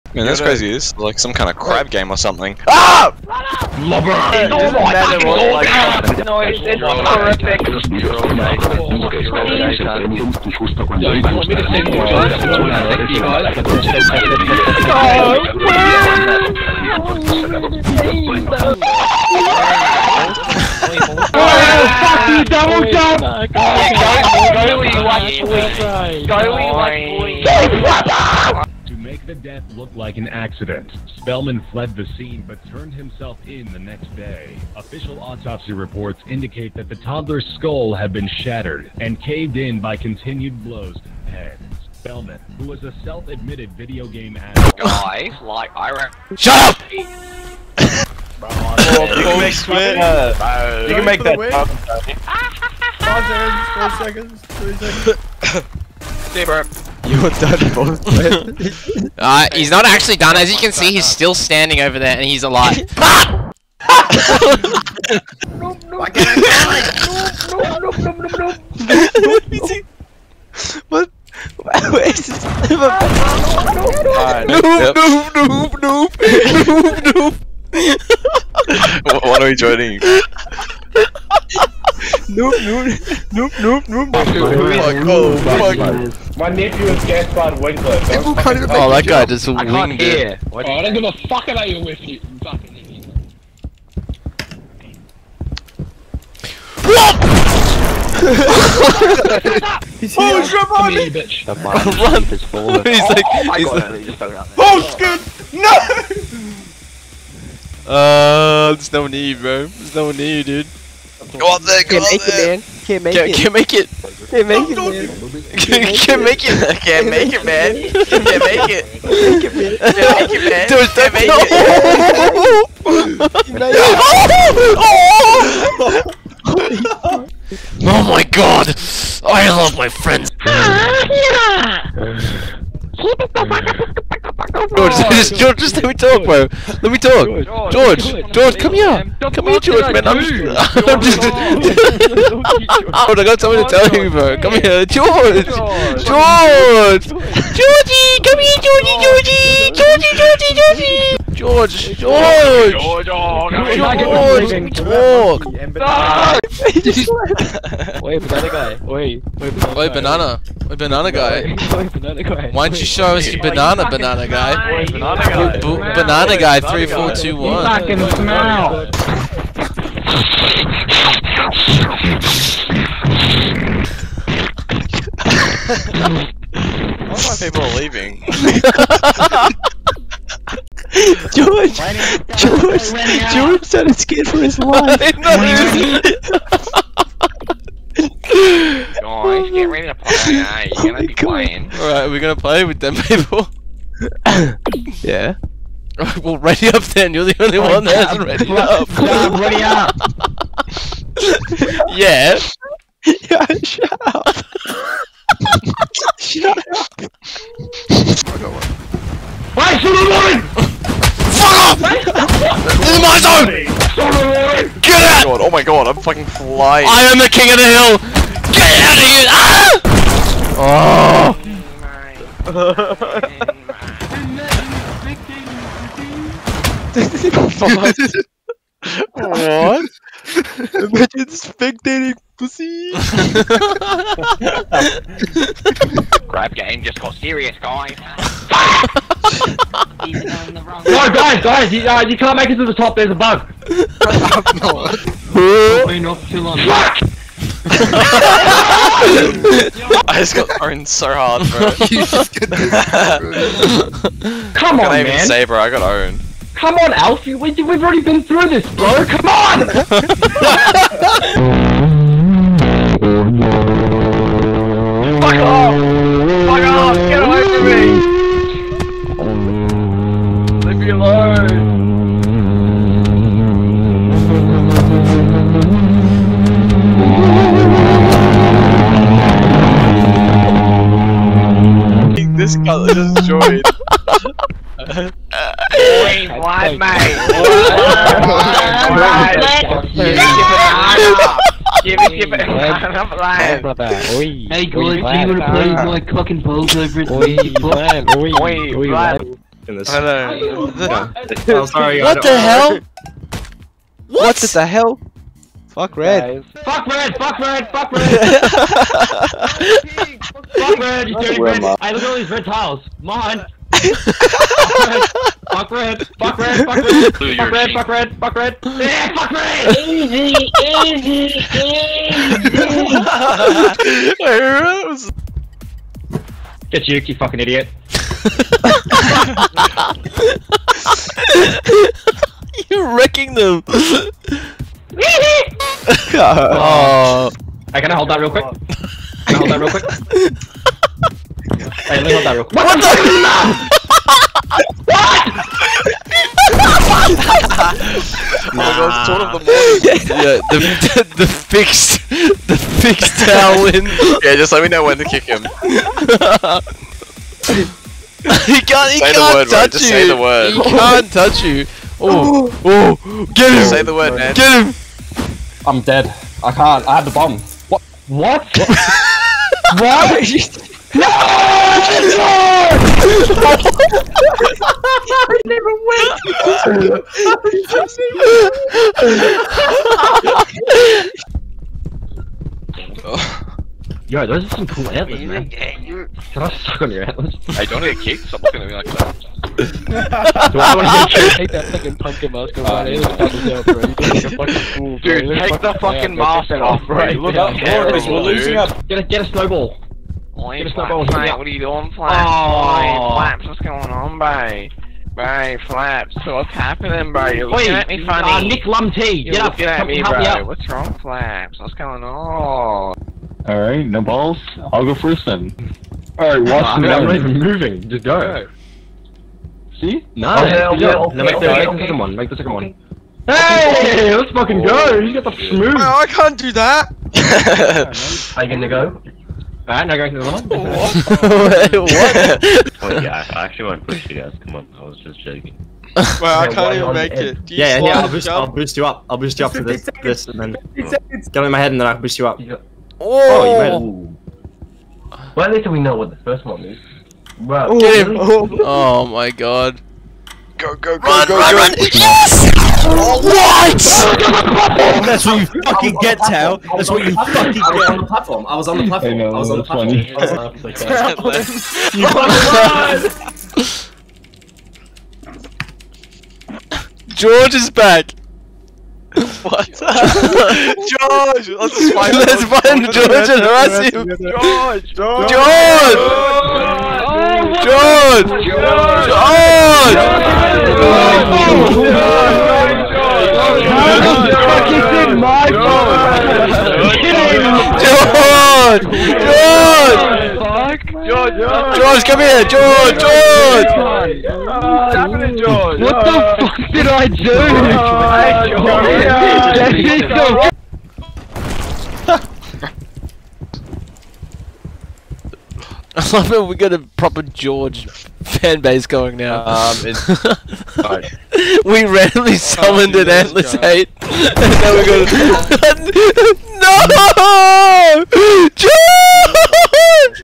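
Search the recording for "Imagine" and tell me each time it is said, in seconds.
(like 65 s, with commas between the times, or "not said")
230 s.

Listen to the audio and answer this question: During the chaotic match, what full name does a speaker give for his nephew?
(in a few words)
Gaspard Winkler.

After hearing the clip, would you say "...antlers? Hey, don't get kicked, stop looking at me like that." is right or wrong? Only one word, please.
right.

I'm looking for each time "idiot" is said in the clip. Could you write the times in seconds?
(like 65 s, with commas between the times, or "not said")
92 s, 327 s.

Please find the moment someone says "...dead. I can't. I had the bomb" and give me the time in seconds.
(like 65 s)
365 s.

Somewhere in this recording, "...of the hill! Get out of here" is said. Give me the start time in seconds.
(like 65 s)
217 s.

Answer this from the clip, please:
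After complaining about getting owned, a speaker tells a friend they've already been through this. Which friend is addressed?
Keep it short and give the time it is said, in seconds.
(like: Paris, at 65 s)
Alfie, at 256 s.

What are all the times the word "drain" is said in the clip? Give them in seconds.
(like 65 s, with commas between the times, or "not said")
not said.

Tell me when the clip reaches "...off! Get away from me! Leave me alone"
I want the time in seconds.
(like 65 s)
266 s.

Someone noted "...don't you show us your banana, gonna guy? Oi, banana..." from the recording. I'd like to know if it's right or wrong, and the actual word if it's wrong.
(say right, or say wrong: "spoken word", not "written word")
wrong: "banana", not "gonna".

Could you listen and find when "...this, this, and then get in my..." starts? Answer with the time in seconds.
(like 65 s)
439 s.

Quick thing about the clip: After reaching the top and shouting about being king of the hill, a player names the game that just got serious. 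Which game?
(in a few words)
Crab Game.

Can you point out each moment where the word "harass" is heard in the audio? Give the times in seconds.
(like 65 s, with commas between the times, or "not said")
473 s.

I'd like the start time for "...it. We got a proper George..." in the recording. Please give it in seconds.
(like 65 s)
506 s.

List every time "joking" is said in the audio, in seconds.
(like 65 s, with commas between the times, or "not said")
435 s.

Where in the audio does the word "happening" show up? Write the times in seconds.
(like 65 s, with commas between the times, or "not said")
406 s, 494 s.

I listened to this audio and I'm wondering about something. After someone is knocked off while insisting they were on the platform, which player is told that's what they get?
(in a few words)
Tao.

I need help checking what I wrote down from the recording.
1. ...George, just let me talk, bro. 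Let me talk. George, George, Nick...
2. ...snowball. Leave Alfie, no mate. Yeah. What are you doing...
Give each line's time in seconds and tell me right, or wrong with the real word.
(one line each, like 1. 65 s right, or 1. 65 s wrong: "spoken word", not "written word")
1. 135 s wrong: "George", not "Nick"
2. 399 s wrong: "Flaps", not "Alfie".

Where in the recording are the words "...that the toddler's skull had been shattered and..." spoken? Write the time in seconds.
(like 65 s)
36 s.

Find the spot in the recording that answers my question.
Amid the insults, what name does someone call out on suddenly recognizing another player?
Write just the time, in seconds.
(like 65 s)
100 s.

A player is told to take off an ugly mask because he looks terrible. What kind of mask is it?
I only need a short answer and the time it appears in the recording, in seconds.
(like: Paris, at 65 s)
Pumpkin, at 391 s.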